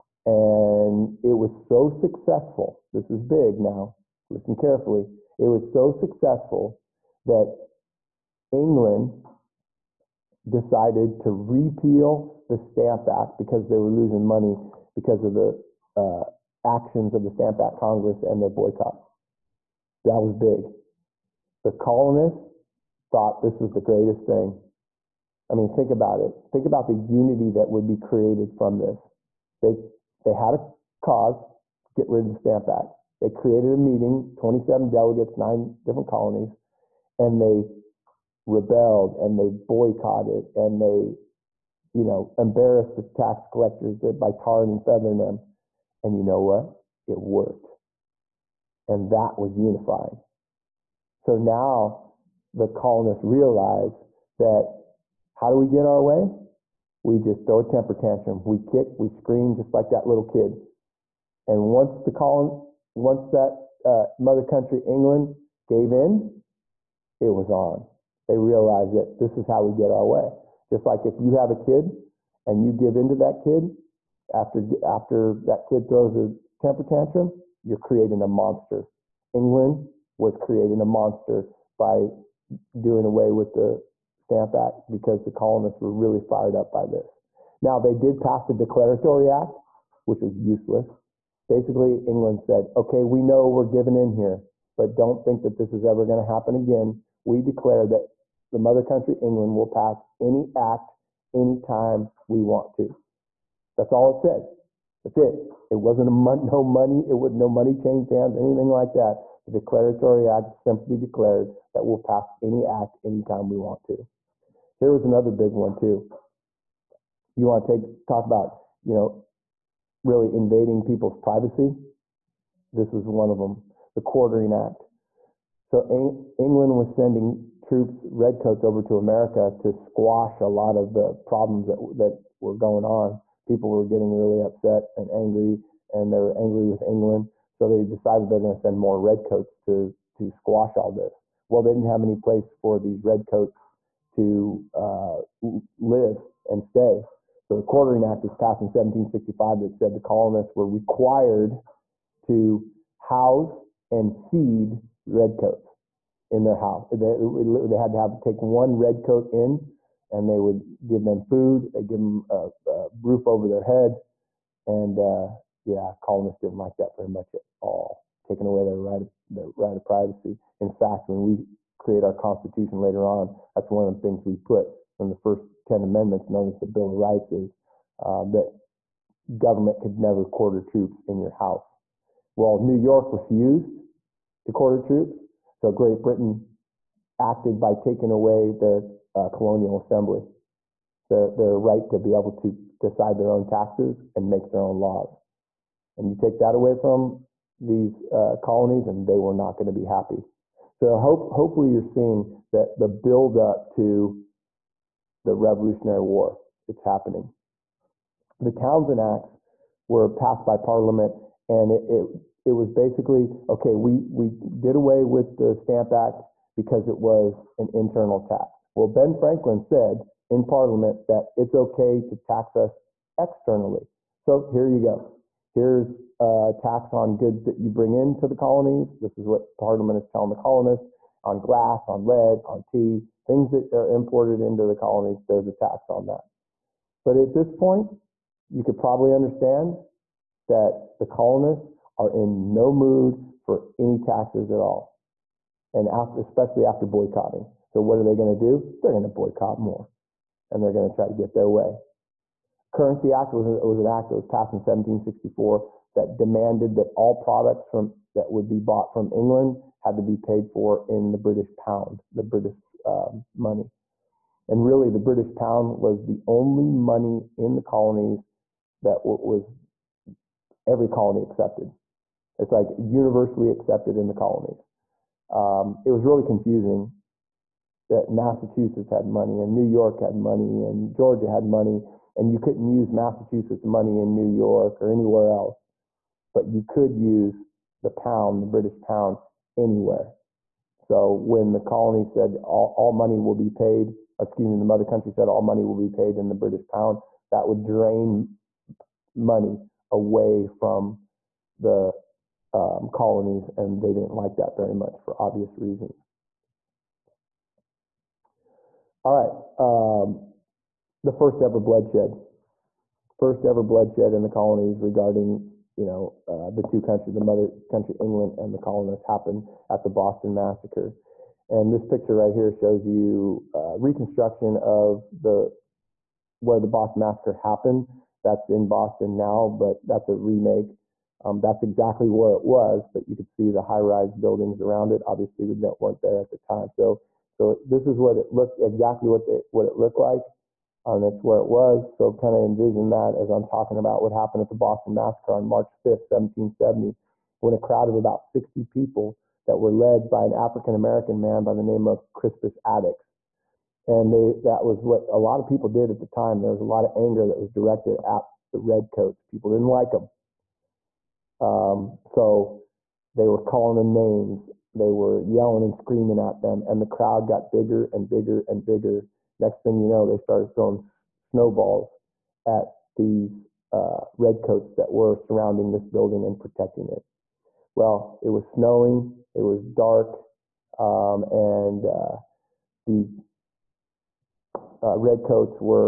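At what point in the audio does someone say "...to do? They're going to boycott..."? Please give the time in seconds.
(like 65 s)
248 s.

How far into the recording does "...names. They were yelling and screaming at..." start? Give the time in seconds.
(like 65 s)
363 s.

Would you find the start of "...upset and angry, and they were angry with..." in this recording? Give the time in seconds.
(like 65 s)
134 s.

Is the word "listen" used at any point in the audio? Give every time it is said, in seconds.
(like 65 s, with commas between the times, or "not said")
4 s.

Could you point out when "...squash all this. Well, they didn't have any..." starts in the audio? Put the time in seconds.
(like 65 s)
140 s.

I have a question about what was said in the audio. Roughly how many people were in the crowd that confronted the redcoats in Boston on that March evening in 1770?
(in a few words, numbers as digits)
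60.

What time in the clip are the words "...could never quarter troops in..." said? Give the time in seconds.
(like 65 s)
179 s.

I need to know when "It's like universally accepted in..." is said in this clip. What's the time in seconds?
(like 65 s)
272 s.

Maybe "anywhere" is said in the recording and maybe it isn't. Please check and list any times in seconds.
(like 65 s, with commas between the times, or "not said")
284 s, 289 s.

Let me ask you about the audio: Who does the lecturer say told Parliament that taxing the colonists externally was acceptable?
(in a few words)
Ben Franklin.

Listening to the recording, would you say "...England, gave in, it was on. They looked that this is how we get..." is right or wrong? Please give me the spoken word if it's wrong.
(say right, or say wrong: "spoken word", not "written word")
wrong: "realized", not "looked".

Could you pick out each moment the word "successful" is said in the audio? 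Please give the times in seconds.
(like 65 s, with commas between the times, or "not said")
1 s, 5 s.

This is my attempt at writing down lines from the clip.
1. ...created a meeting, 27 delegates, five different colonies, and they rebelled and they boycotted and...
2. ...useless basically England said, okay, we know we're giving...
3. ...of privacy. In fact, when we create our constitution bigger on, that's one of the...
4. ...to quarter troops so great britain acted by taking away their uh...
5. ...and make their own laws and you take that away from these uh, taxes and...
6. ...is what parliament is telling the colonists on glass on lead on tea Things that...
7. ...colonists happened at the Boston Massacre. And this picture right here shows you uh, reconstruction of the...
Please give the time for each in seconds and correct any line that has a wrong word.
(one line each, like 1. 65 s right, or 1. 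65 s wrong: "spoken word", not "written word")
1. 33 s wrong: "nine", not "five"
2. 90 s right
3. 169 s wrong: "later", not "bigger"
4. 184 s right
5. 194 s wrong: "colonies", not "taxes"
6. 229 s right
7. 318 s right.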